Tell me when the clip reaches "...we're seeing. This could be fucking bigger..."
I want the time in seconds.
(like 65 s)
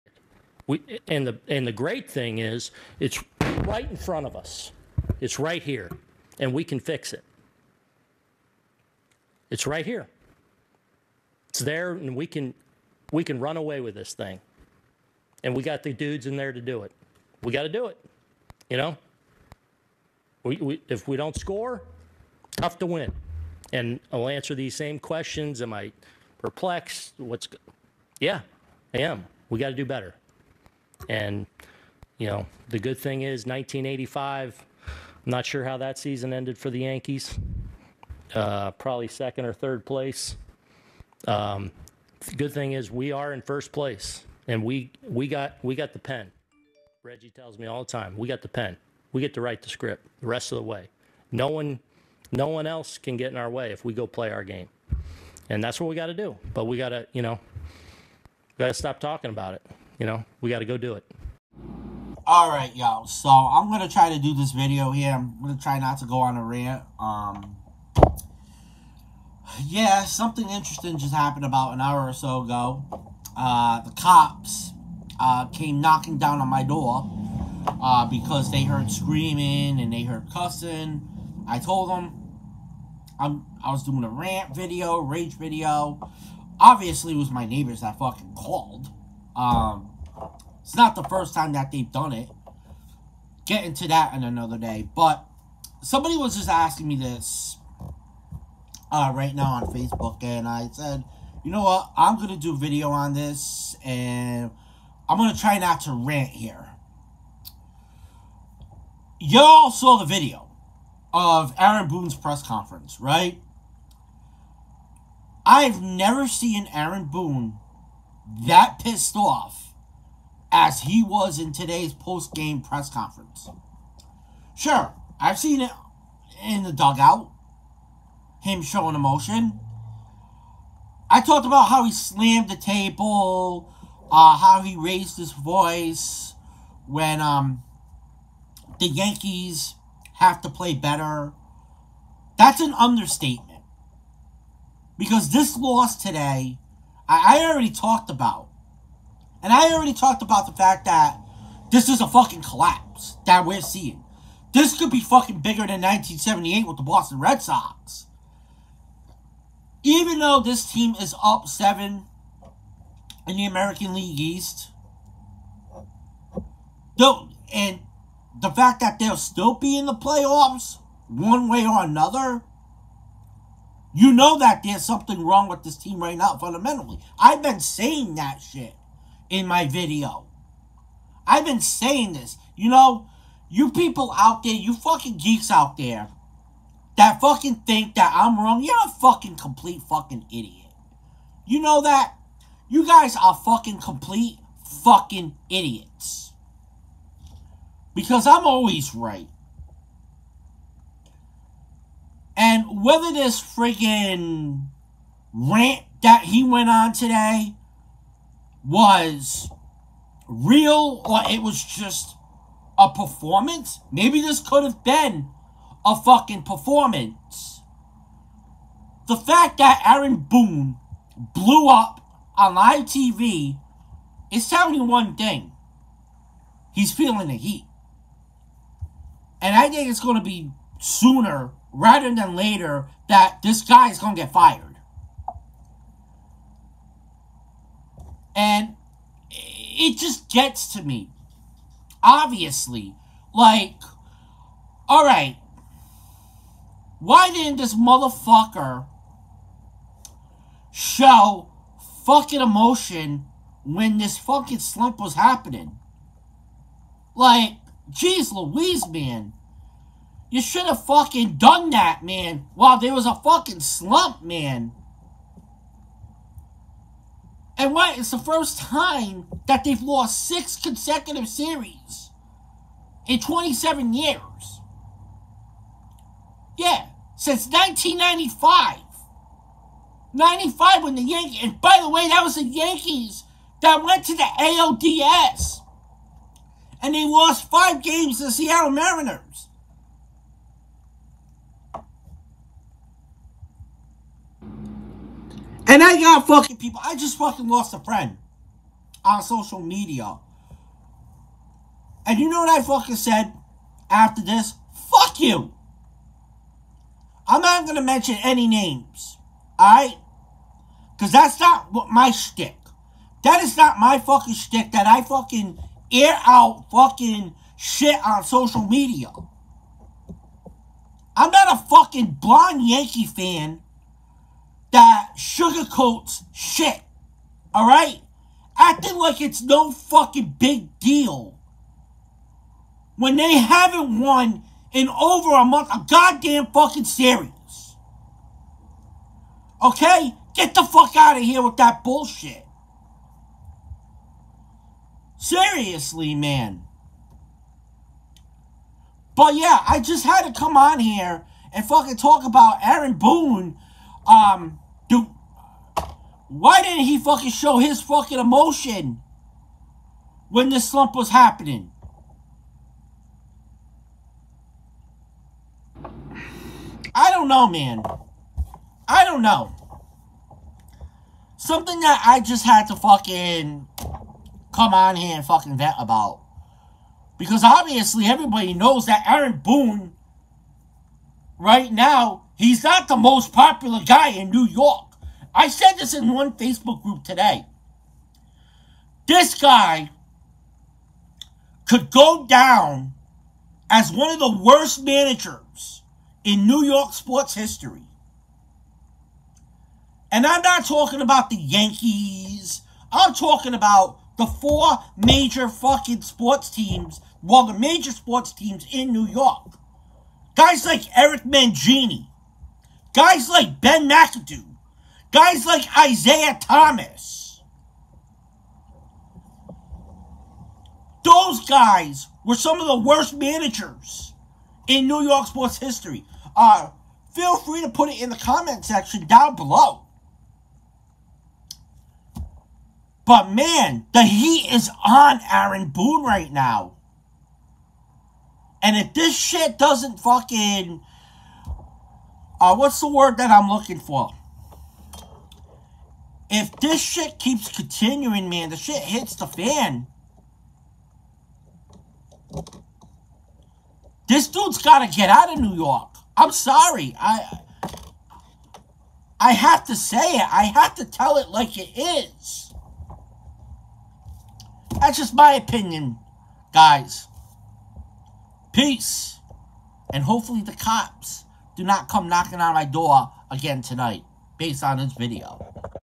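153 s.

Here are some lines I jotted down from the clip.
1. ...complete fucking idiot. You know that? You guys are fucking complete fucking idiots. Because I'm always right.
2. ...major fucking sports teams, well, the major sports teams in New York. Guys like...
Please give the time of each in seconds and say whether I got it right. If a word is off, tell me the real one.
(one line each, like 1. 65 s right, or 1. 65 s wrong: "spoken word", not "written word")
1. 189 s right
2. 404 s right.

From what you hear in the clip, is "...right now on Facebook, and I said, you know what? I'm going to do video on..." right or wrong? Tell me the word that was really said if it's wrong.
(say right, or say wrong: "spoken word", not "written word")
right.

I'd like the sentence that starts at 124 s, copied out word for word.
Sure, I've seen it in the dugout, him showing emotion.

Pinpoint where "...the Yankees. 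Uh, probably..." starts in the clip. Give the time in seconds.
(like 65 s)
36 s.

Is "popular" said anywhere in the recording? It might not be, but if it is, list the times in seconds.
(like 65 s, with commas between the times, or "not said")
383 s.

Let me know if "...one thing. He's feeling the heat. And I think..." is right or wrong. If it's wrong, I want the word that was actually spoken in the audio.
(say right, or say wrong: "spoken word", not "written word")
right.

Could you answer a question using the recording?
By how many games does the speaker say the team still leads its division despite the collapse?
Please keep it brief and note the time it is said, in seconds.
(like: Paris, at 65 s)
7, at 161 s.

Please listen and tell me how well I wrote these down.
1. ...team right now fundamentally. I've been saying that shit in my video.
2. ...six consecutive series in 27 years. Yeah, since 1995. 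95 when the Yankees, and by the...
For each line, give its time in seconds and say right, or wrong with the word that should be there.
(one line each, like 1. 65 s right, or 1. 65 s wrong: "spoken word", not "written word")
1. 175 s right
2. 270 s right.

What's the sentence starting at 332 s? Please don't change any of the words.
When they haven't won in over a month, a goddamn fucking series.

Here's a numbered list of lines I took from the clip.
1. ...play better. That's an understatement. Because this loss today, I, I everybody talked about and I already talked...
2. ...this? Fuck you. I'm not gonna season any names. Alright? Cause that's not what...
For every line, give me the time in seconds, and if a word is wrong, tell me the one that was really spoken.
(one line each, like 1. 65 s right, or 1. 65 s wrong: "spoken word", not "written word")
1. 140 s wrong: "already", not "everybody"
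2. 304 s wrong: "mention", not "season".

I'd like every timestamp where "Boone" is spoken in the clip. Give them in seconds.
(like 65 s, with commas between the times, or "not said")
111 s, 117 s, 220 s, 352 s, 379 s, 435 s.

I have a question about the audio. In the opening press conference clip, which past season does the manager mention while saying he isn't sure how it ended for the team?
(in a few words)
1985.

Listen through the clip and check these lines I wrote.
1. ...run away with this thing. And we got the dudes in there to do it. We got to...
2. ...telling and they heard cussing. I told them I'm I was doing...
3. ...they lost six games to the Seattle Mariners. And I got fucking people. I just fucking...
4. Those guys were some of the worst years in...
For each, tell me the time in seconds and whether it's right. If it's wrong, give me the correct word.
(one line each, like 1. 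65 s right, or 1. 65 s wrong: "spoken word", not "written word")
1. 13 s right
2. 78 s wrong: "screaming", not "telling"
3. 286 s wrong: "five", not "six"
4. 421 s wrong: "managers", not "years".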